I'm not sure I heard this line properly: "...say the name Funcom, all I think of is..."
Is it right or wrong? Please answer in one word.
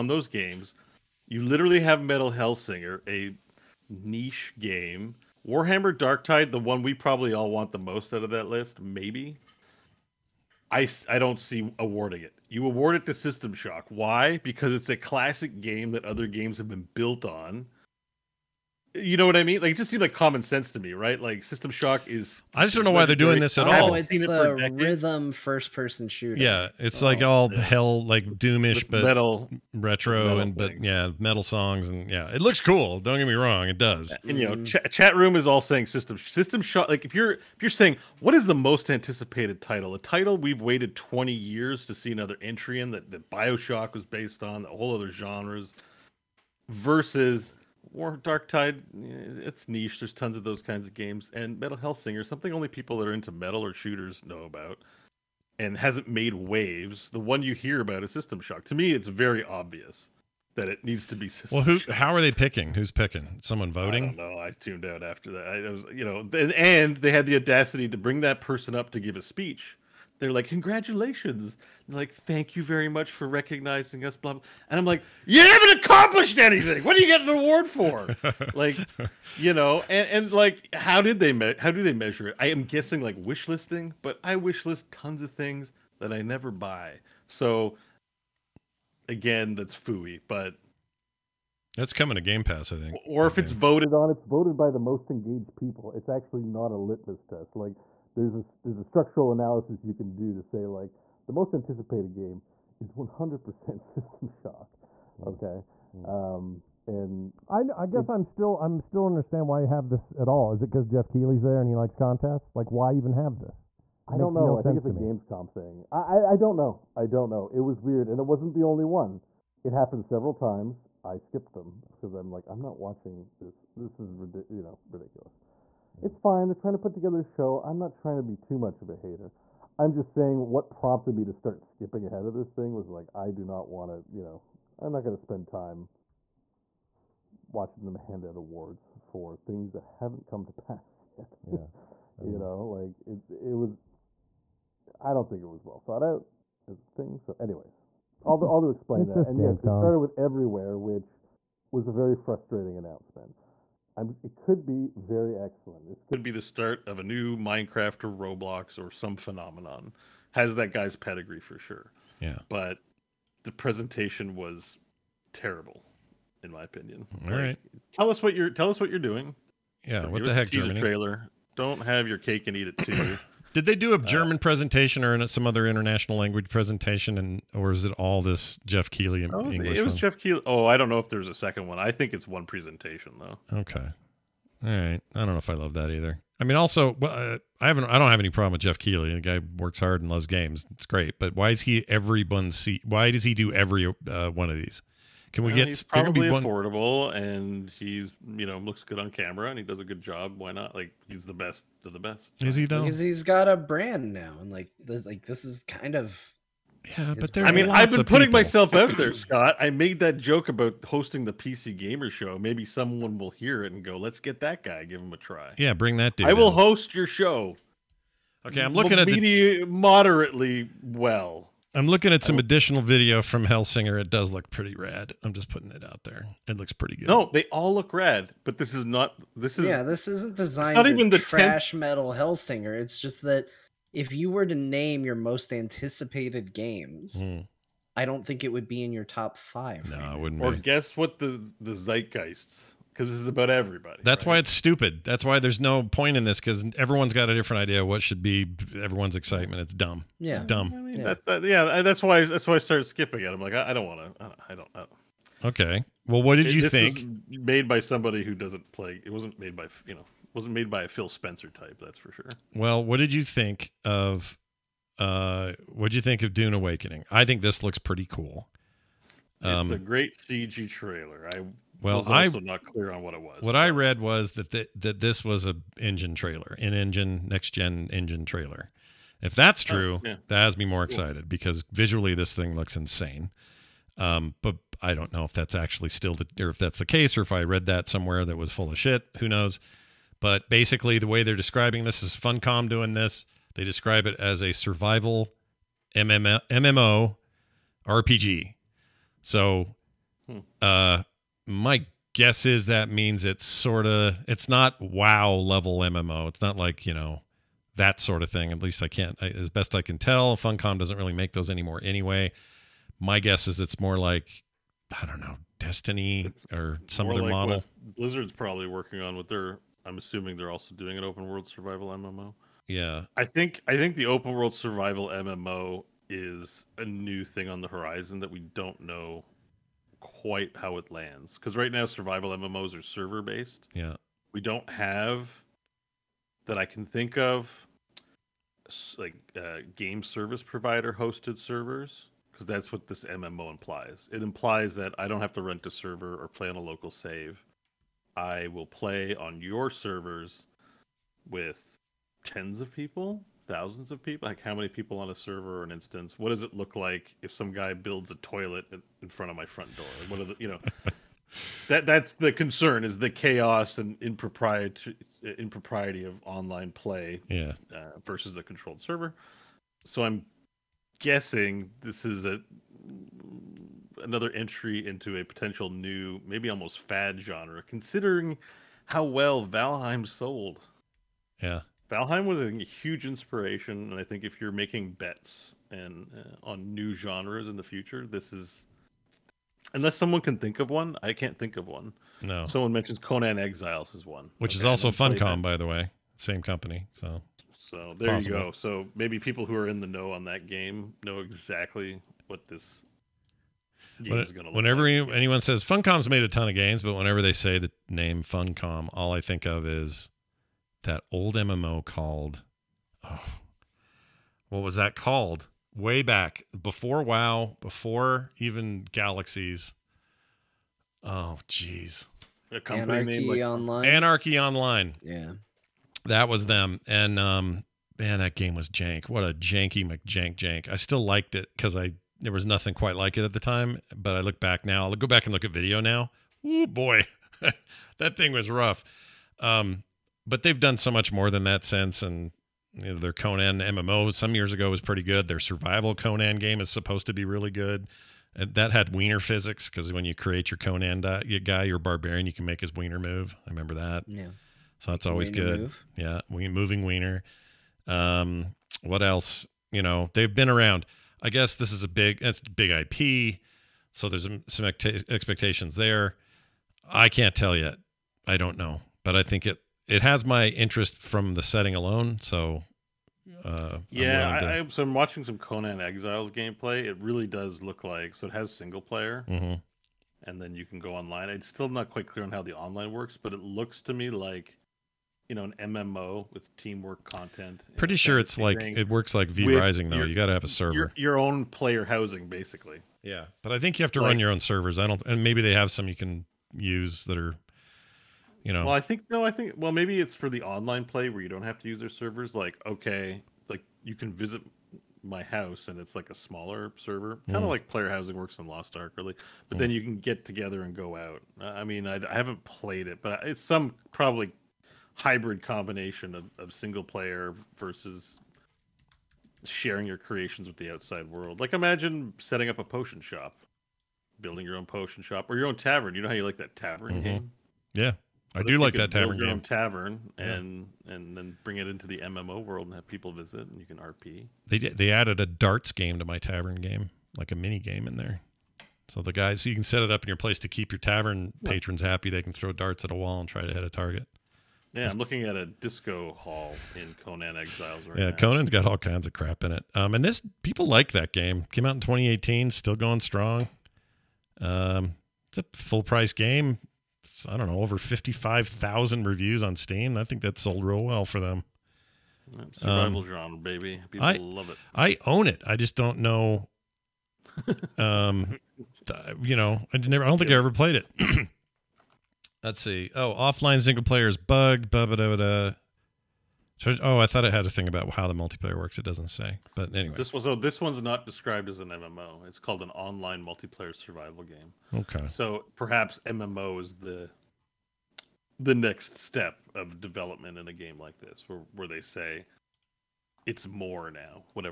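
right.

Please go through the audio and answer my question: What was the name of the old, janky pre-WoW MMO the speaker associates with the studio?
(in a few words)
Anarchy Online.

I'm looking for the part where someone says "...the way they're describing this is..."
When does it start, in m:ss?
4:50.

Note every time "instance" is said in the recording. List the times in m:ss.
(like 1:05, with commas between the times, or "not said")
5:55.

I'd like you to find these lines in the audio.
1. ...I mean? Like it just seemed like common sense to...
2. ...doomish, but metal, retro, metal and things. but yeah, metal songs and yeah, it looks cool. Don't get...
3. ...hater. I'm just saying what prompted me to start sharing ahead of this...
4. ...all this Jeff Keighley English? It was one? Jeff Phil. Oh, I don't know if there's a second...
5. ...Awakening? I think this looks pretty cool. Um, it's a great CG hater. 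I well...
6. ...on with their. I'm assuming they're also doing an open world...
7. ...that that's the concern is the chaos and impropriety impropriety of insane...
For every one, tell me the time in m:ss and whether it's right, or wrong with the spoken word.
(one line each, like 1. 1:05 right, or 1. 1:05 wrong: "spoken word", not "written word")
1. 0:19 right
2. 0:28 right
3. 2:08 wrong: "skipping", not "sharing"
4. 2:57 wrong: "Keighley", not "Phil"
5. 4:26 wrong: "trailer", not "hater"
6. 5:18 right
7. 6:01 wrong: "online", not "insane".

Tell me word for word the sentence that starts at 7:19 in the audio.
Um, but they've done so much more than that since.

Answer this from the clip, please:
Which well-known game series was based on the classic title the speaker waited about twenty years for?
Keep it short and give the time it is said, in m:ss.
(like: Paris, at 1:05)
Bioshock, at 0:43.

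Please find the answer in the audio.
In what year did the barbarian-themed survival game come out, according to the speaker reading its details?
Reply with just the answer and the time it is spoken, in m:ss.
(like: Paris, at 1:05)
2018, at 9:11.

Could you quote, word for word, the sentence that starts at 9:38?
It doesn't say, but anyway, this so oh, this one's not described as an MMO.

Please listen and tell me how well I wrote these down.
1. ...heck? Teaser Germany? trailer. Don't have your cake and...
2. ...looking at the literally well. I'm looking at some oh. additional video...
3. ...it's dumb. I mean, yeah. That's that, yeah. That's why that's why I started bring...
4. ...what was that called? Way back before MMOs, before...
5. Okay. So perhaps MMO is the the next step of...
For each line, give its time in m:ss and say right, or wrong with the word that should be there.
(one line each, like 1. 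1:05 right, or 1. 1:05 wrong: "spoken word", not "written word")
1. 2:50 right
2. 3:38 wrong: "moderately", not "literally"
3. 4:10 wrong: "skipping", not "bring"
4. 6:54 wrong: "WoW", not "MMOs"
5. 9:44 right.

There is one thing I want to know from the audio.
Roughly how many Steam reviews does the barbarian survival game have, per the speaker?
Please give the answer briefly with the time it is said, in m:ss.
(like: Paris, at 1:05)
over 55,000, at 9:17.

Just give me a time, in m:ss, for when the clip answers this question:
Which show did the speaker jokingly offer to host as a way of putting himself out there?
3:31.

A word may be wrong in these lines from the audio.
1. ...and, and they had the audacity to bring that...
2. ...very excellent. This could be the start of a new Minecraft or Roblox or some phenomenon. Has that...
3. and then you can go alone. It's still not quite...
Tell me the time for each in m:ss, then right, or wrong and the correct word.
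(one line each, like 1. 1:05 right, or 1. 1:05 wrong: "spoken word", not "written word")
1. 1:06 right
2. 2:34 right
3. 8:00 wrong: "online", not "alone".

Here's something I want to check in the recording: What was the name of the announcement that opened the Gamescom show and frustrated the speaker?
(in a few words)
Everywhere.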